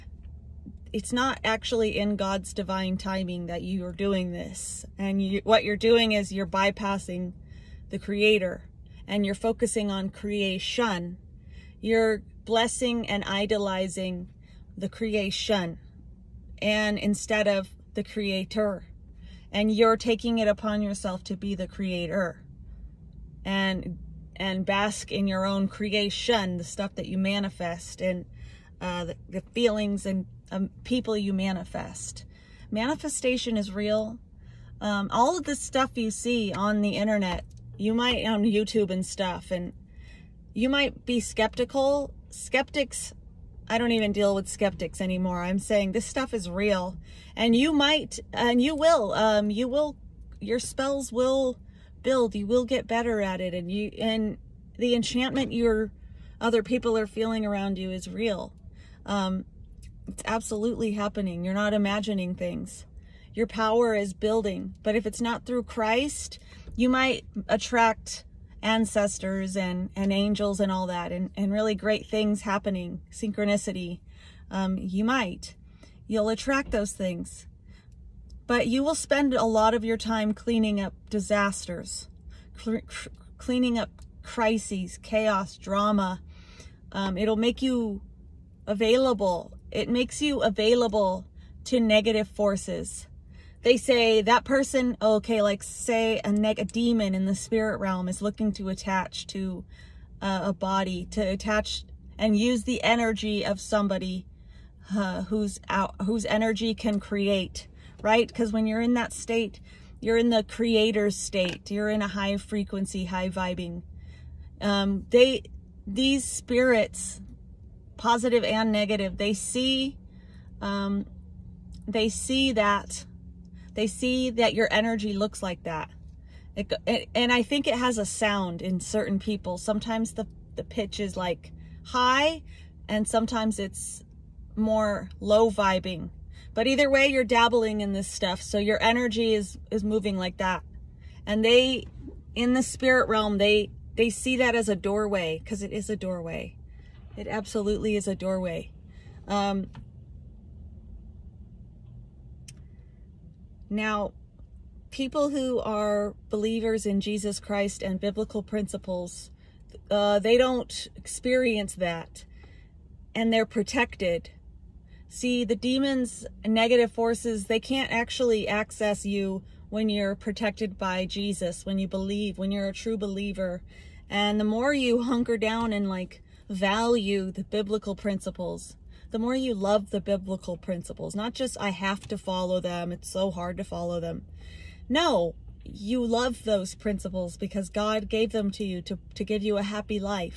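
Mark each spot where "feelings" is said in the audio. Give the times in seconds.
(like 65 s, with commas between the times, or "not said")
29 s, 57 s.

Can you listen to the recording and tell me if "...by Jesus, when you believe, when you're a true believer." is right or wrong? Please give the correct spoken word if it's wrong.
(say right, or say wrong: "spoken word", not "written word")
right.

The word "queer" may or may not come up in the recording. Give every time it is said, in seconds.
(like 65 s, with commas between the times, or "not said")
not said.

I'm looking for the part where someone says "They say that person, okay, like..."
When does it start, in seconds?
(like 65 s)
93 s.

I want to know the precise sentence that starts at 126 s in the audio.
It, and I think it has a sound in certain people.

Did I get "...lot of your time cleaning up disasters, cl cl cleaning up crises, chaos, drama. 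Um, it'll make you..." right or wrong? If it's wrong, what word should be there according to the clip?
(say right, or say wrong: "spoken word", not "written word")
right.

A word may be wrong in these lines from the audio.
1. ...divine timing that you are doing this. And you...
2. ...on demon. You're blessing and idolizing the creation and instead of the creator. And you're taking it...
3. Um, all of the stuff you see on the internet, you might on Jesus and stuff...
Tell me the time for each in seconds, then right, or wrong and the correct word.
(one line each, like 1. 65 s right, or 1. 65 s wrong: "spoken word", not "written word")
1. 2 s right
2. 9 s wrong: "creation", not "demon"
3. 34 s wrong: "YouTube", not "Jesus".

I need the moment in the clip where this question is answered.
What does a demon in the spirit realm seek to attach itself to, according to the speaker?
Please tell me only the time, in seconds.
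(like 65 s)
100 s.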